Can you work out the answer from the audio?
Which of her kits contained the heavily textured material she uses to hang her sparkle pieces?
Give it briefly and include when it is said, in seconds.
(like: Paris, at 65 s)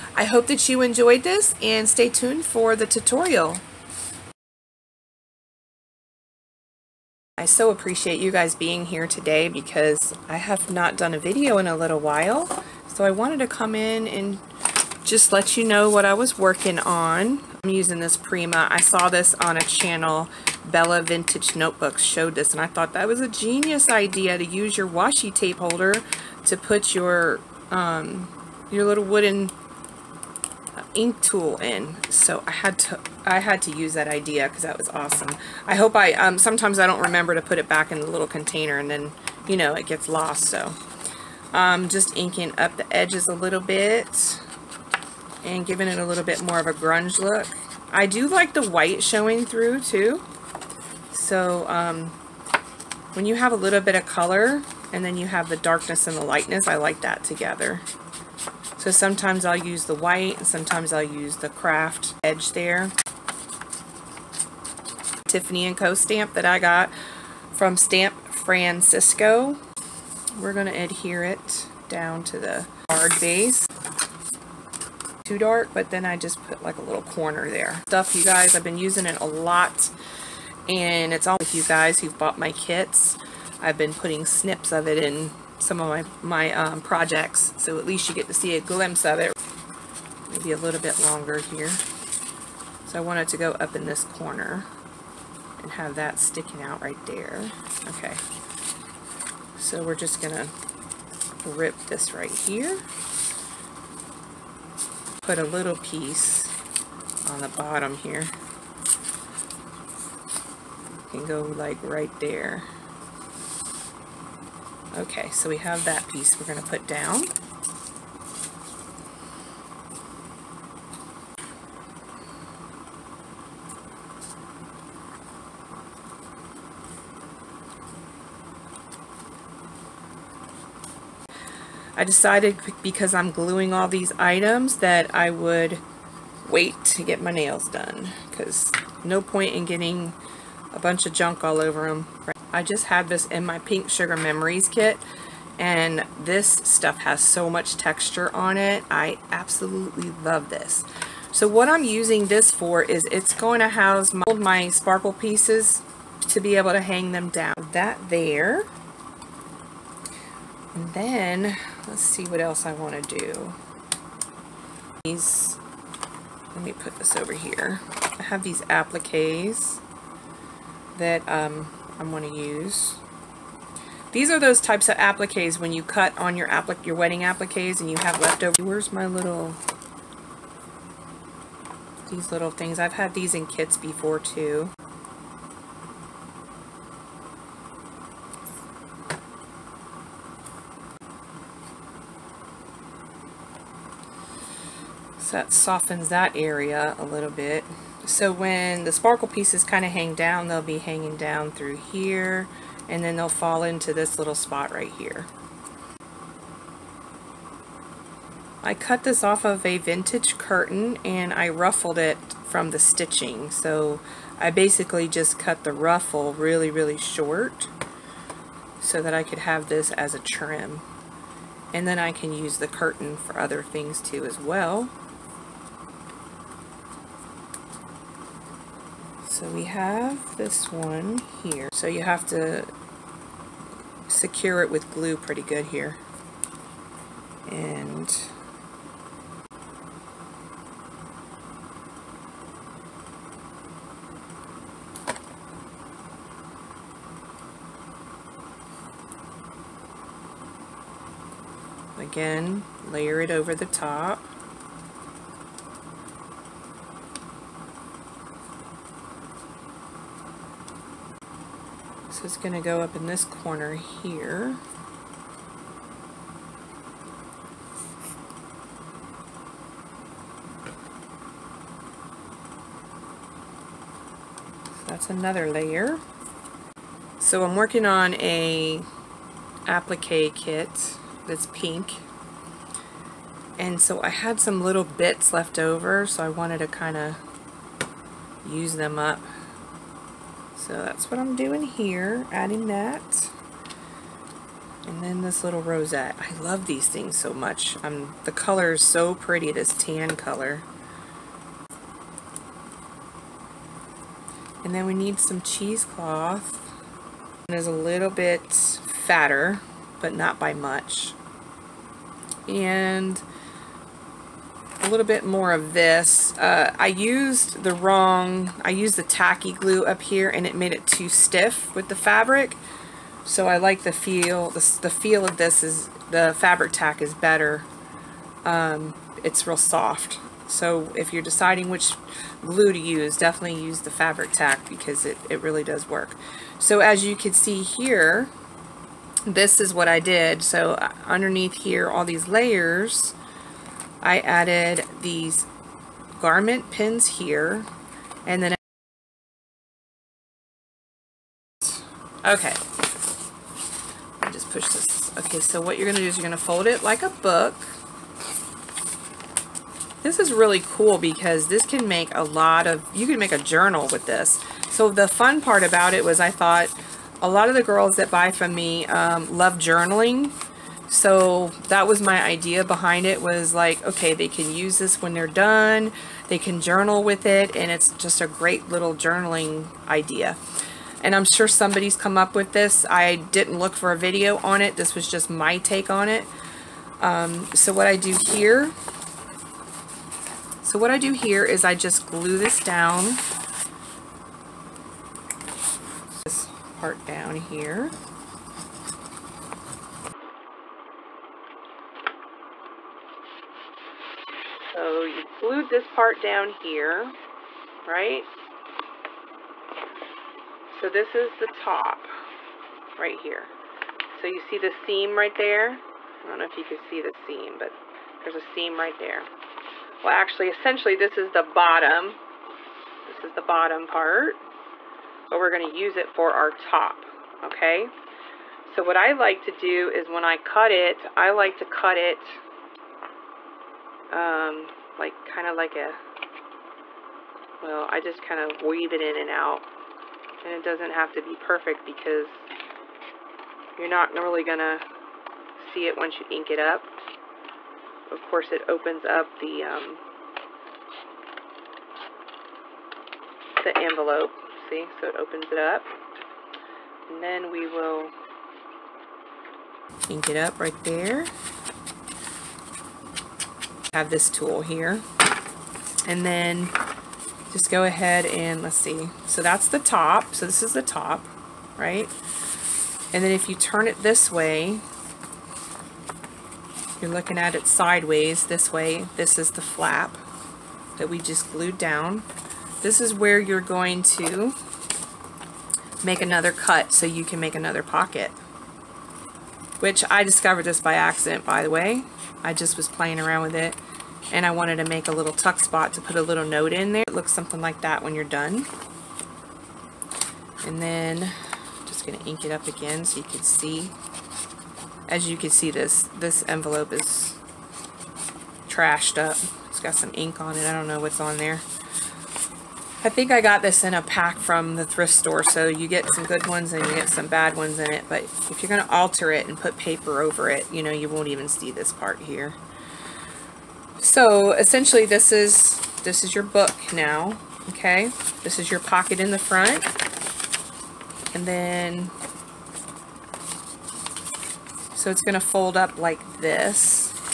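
Pink Sugar Memories, at 143 s.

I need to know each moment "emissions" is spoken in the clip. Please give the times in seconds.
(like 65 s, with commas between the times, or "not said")
not said.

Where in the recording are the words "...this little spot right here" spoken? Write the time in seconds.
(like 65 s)
203 s.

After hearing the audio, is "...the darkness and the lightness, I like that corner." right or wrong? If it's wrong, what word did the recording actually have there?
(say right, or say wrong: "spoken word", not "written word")
wrong: "together", not "corner".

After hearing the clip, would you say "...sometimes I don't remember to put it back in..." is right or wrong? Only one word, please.
right.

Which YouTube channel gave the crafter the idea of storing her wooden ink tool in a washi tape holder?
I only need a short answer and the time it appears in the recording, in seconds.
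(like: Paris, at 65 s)
Bella Vintage Notebooks, at 20 s.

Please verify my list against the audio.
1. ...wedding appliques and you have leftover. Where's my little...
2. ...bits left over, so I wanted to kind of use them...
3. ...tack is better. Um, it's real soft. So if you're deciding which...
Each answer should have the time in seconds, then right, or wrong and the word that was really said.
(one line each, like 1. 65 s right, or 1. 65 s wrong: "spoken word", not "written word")
1. 176 s right
2. 284 s right
3. 326 s right.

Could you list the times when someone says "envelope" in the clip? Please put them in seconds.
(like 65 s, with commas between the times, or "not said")
453 s, 506 s.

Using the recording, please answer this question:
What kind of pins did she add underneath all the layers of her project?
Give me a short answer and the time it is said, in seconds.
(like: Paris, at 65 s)
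garment pins, at 346 s.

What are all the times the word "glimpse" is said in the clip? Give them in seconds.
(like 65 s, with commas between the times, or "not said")
88 s.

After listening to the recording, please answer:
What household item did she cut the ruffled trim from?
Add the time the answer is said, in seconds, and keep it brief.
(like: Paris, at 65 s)
a vintage curtain, at 209 s.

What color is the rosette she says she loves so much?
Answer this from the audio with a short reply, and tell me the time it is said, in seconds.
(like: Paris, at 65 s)
tan, at 299 s.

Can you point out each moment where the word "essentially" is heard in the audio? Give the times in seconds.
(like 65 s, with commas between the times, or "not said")
420 s, 524 s.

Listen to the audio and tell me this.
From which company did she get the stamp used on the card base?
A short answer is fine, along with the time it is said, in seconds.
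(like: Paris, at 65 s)
Stamp Francisco, at 67 s.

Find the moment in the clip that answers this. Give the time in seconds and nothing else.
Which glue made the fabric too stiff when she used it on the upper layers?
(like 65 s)
319 s.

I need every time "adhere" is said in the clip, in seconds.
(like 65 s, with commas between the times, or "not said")
70 s.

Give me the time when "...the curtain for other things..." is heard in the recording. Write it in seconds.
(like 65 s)
222 s.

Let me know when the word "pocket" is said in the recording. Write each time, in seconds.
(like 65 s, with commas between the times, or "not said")
487 s, 528 s.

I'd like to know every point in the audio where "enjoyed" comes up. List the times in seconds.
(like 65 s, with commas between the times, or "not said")
0 s.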